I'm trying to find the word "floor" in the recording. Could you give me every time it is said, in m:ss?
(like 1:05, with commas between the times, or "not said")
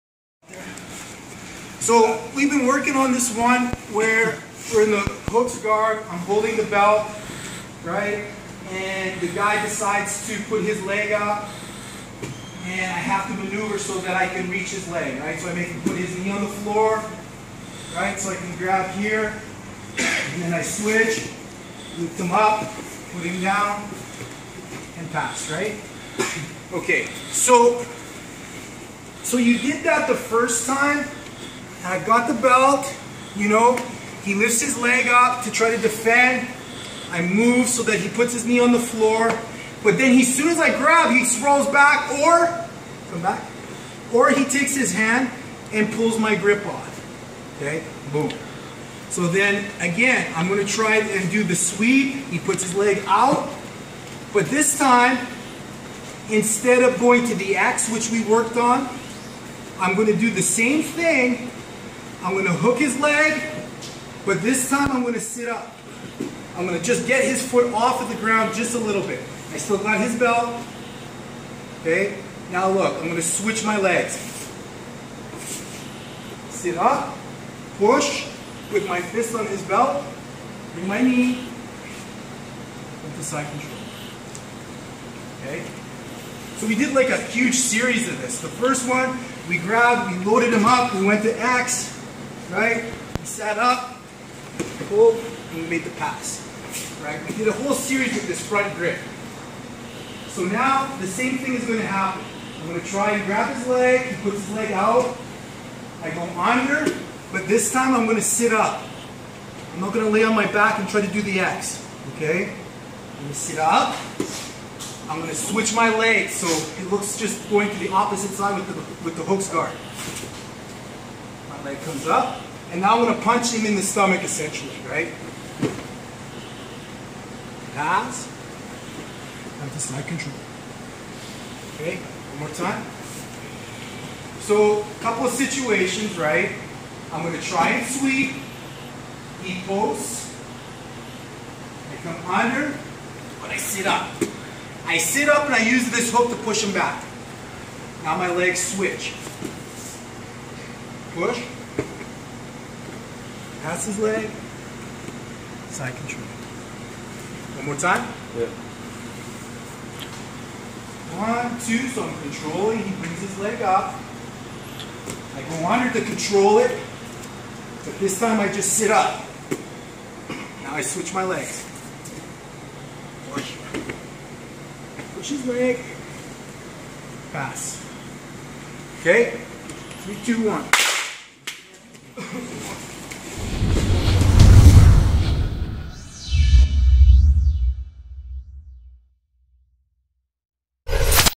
0:16, 0:38.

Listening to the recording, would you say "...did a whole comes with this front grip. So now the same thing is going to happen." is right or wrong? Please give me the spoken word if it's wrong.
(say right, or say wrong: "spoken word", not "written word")
wrong: "series", not "comes".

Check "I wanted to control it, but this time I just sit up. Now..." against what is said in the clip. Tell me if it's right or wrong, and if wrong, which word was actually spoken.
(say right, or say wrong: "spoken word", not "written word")
right.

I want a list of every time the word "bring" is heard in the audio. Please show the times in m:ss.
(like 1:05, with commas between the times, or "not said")
1:20, 2:43.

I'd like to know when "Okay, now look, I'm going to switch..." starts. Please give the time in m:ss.
1:11.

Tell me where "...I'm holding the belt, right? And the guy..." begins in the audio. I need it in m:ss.
0:06.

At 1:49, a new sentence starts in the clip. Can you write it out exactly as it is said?
I'm not going to lay on my back and try to do the X, okay?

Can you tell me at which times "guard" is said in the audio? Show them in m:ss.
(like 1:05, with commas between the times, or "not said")
0:05, 1:59.